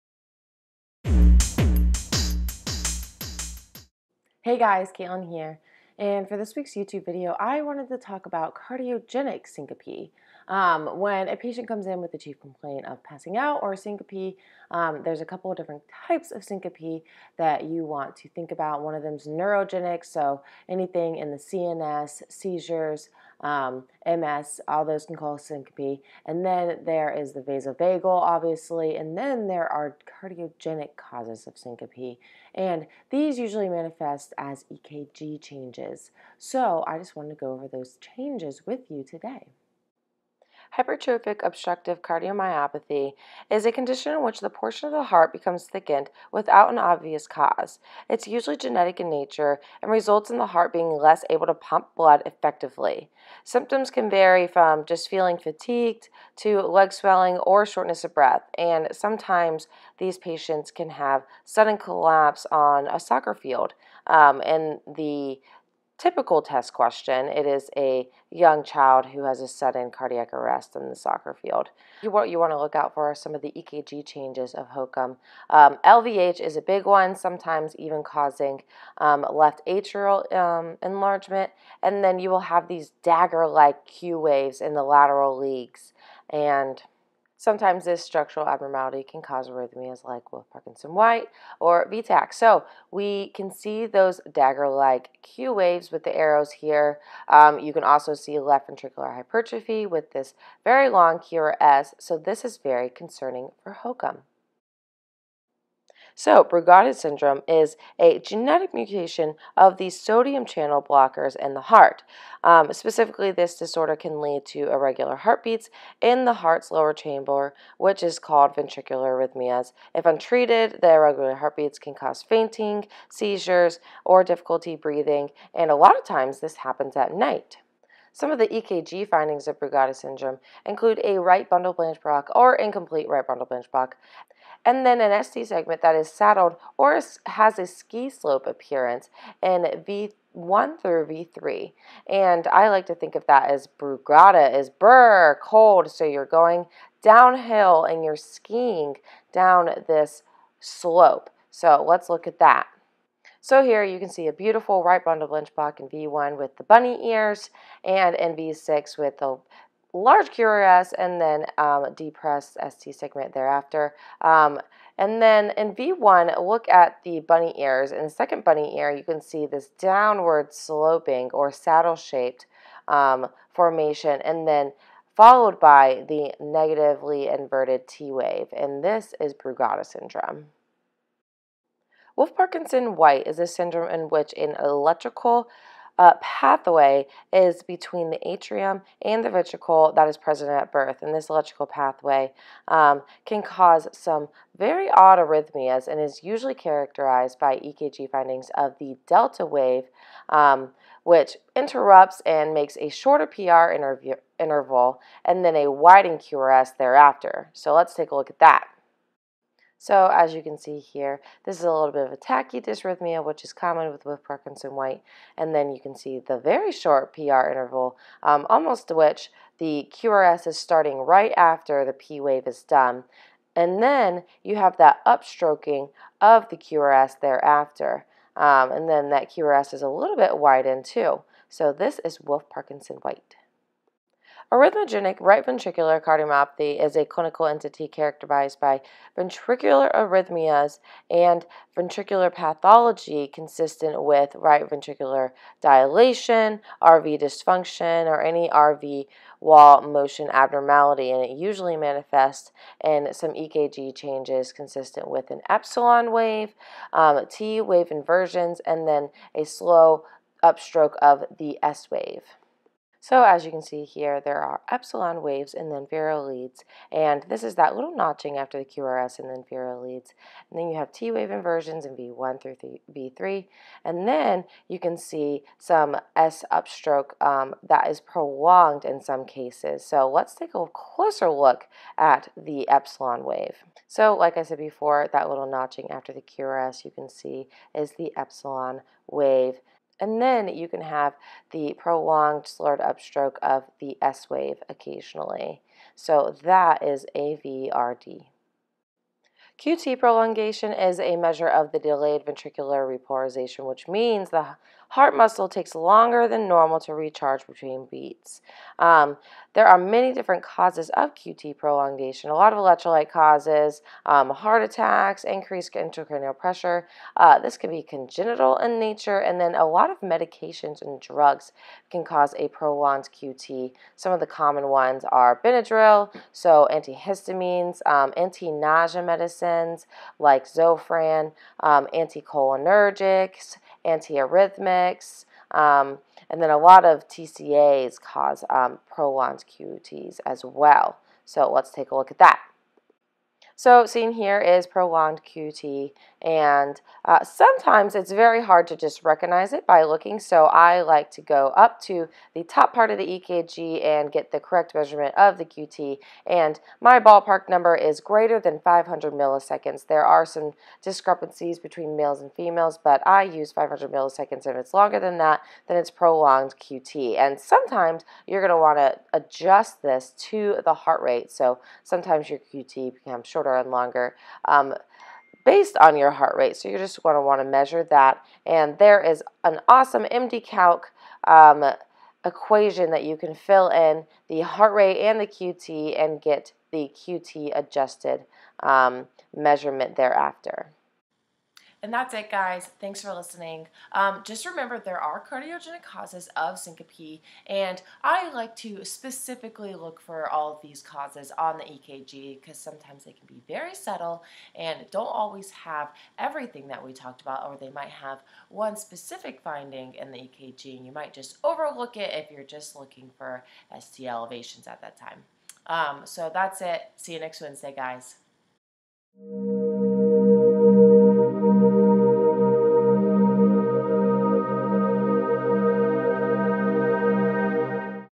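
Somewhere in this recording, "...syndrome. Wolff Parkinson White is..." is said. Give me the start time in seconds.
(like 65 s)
179 s.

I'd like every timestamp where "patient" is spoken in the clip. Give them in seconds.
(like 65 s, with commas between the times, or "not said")
11 s, 60 s.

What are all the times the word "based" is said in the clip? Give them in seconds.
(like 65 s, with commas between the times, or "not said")
375 s.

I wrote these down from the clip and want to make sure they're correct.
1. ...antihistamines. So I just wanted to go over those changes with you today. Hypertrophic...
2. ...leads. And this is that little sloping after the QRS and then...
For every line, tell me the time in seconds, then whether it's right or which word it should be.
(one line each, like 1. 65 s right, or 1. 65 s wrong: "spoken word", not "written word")
1. 35 s wrong: "changes", not "antihistamines"
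2. 266 s wrong: "notching", not "sloping".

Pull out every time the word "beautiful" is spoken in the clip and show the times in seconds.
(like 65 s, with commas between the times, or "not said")
154 s.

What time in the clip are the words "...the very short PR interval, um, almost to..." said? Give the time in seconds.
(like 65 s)
216 s.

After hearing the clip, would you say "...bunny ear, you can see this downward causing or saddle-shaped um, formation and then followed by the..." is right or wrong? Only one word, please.
wrong.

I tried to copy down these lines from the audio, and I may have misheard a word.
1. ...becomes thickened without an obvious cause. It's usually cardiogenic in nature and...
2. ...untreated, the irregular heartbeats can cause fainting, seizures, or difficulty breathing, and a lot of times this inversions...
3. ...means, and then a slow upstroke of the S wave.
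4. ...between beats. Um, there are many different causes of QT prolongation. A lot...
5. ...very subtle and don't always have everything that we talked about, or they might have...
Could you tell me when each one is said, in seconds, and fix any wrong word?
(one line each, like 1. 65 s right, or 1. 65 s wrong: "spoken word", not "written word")
1. 45 s wrong: "genetic", not "cardiogenic"
2. 120 s wrong: "happens", not "inversions"
3. 257 s wrong: "inversions", not "means"
4. 307 s right
5. 403 s right.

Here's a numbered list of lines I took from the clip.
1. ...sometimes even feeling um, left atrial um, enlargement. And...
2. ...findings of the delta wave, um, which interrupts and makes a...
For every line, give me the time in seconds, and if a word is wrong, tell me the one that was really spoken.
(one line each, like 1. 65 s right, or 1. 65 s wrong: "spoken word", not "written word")
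1. 77 s wrong: "causing", not "feeling"
2. 198 s right.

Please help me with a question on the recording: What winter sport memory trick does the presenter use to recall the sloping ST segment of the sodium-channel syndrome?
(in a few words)
skiing.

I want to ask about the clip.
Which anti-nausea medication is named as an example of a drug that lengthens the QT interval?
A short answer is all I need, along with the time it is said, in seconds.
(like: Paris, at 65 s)
Zofran, at 330 s.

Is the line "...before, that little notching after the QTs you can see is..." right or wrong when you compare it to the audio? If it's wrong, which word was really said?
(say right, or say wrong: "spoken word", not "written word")
wrong: "QRS", not "QTs".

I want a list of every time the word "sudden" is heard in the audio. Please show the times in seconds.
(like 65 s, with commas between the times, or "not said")
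61 s, 69 s.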